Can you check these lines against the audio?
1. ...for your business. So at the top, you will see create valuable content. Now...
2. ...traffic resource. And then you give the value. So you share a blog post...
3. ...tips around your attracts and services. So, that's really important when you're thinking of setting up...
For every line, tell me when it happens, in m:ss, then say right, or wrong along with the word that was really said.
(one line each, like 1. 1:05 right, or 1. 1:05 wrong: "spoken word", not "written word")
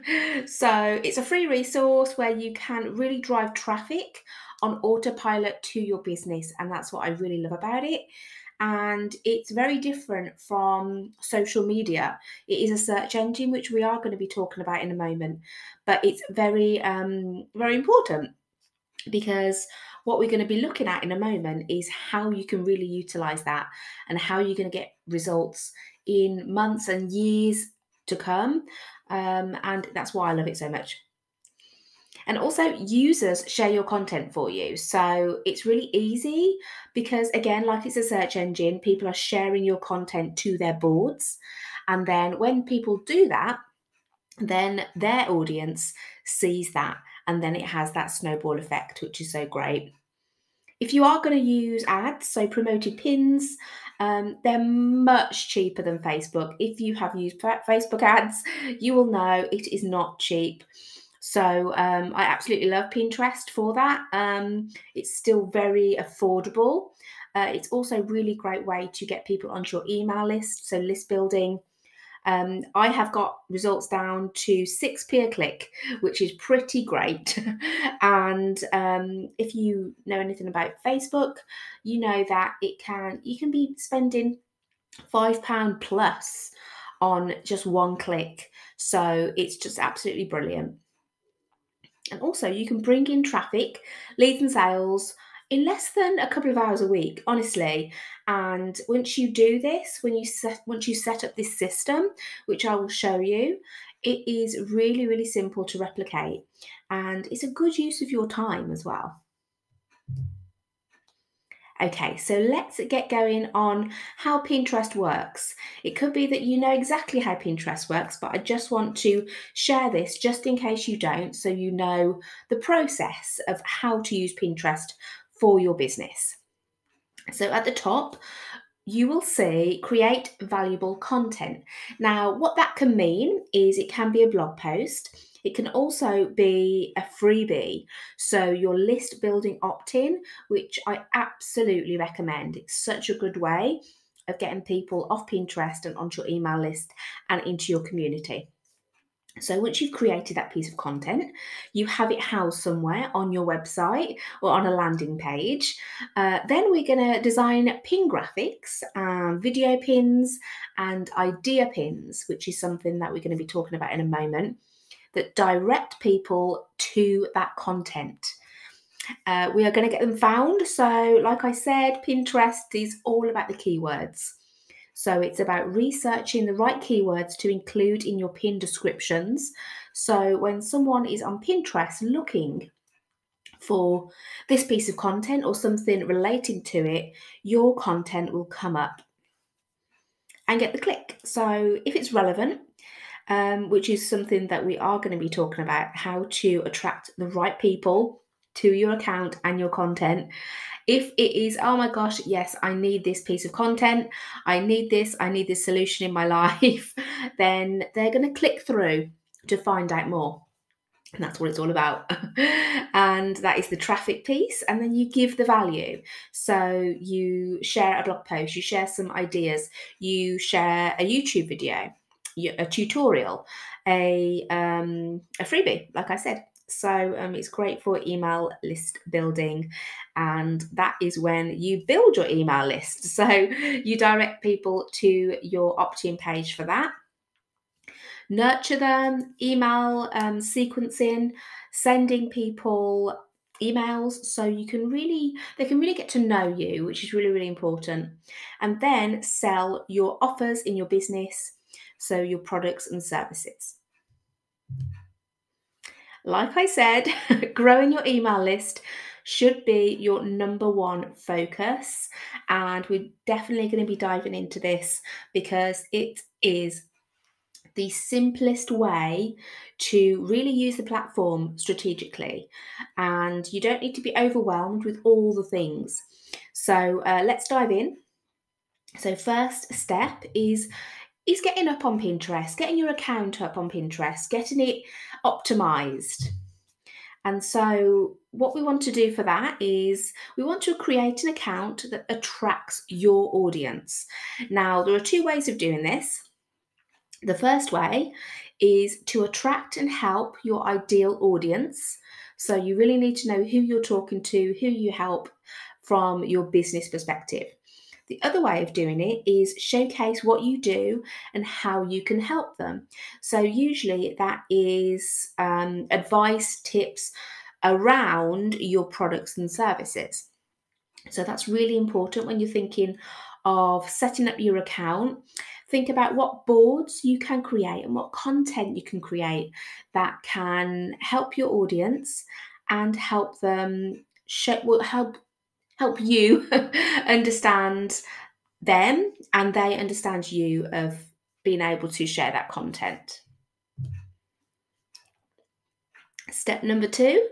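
1. 2:05 right
2. 3:33 wrong: "piece", not "resource"
3. 5:16 wrong: "products", not "attracts".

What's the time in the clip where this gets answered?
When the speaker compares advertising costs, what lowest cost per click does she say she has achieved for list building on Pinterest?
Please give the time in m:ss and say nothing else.
1:14.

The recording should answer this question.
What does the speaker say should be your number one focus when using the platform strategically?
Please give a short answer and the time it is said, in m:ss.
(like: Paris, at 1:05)
growing your email list, at 4:17.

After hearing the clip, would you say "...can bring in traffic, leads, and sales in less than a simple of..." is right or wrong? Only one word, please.
wrong.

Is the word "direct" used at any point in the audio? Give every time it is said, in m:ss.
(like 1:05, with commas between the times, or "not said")
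2:45, 3:53.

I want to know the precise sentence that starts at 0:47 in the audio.
And then it has that snowball effect, which is so great.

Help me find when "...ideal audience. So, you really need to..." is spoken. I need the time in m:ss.
5:00.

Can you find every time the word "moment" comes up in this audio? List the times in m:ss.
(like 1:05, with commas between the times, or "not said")
0:14, 0:21, 2:44.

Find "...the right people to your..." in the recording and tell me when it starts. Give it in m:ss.
3:17.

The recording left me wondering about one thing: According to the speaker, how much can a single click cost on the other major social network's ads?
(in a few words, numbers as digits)
£5 plus.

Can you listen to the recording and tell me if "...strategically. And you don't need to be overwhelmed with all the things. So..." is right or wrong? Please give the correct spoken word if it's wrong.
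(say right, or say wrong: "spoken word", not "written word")
right.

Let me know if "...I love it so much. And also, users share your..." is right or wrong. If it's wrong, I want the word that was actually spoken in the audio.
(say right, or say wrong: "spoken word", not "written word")
right.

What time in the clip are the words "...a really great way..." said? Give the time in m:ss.
1:07.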